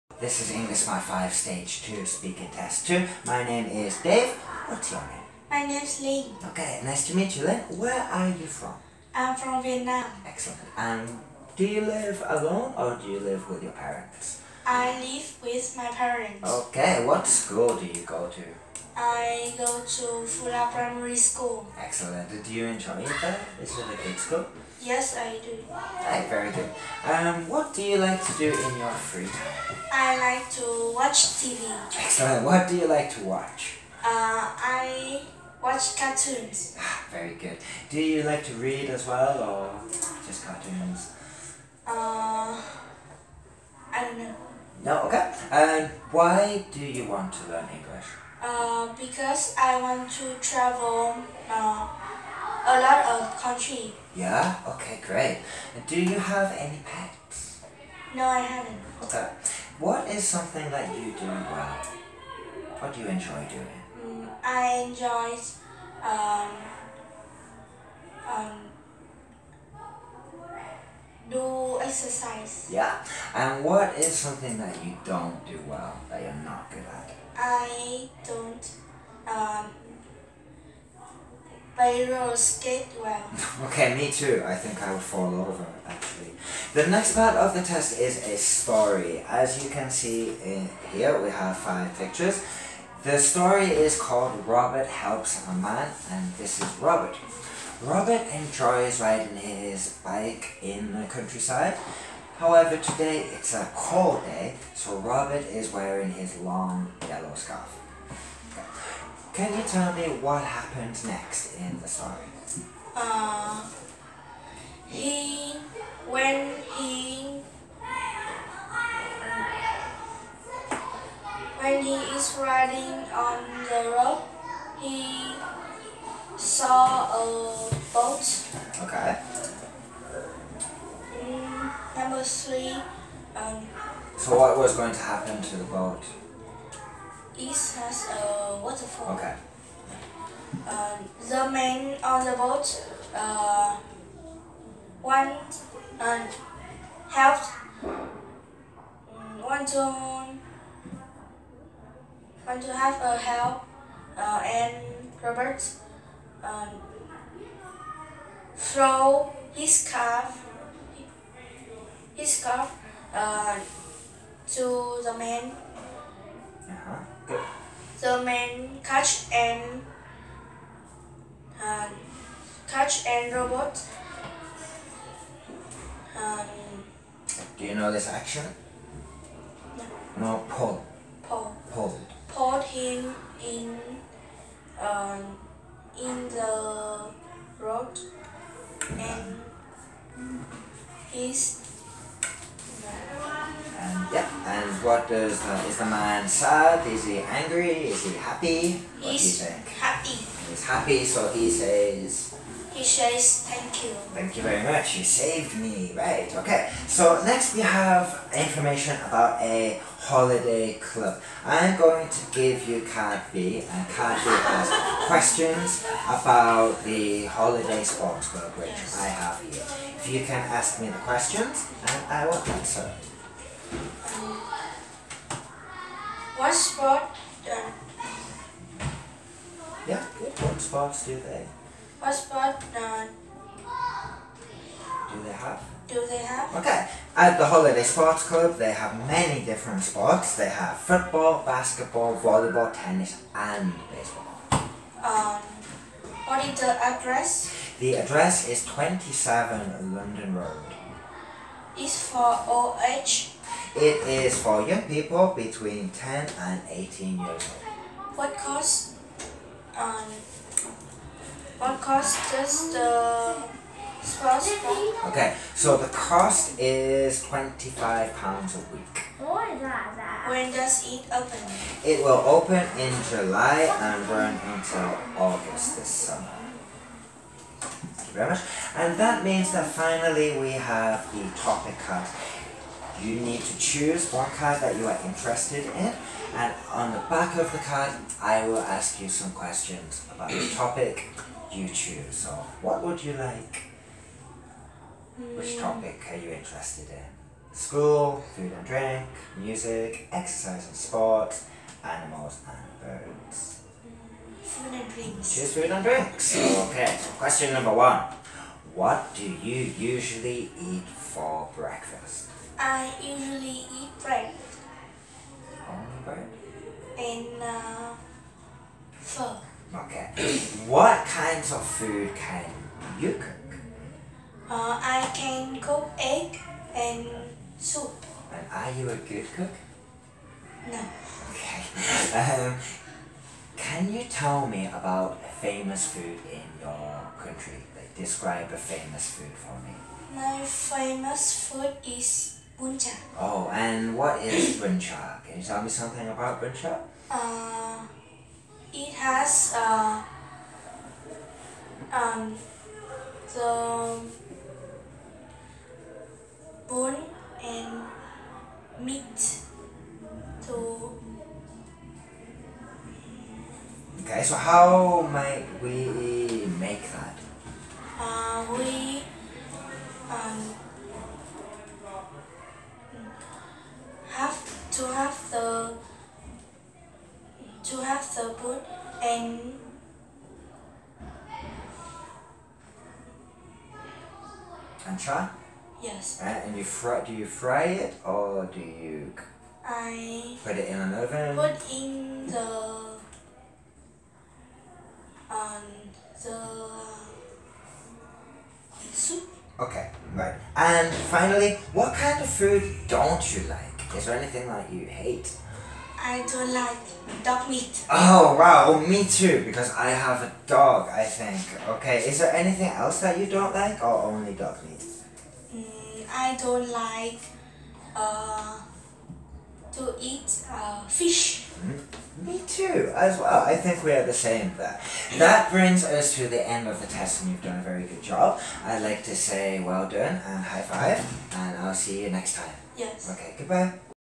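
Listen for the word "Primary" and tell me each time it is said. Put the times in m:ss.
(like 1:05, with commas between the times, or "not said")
0:20.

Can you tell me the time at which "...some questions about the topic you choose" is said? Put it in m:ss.
4:49.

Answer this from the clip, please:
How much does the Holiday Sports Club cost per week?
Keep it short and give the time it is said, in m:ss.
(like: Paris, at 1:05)
£25, at 4:27.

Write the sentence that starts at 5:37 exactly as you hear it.
Like describe a famous food for me.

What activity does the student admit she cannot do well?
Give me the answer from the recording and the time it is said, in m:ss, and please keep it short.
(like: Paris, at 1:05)
Roller skate, at 1:21.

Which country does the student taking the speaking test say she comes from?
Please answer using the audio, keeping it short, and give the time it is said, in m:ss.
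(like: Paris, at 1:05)
Vietnam, at 0:09.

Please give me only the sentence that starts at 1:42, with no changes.
However, today it's a cold day, so Robert is wearing his long yellow scarf.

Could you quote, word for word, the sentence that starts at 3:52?
What sport uh, Do they have?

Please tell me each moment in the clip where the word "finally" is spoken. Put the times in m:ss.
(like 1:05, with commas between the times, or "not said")
4:39, 6:40.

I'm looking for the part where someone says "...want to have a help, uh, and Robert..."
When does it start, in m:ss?
2:32.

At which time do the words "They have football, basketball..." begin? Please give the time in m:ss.
4:00.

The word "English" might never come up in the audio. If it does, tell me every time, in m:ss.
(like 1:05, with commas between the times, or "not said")
0:00, 0:47.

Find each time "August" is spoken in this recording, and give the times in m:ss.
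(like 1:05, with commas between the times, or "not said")
4:35.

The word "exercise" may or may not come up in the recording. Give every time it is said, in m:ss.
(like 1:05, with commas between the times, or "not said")
1:11, 5:00.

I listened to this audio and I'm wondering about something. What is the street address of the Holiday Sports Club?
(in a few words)
27 London Road.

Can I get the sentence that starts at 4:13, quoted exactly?
It is for young people between 10 and 18 years old.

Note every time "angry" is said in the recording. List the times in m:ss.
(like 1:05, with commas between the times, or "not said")
3:17.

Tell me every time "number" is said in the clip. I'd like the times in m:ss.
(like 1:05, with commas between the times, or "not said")
2:11, 5:07.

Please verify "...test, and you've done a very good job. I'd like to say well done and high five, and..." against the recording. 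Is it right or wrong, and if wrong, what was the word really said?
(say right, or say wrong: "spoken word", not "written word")
right.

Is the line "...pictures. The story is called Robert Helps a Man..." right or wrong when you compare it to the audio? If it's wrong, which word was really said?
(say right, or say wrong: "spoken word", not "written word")
right.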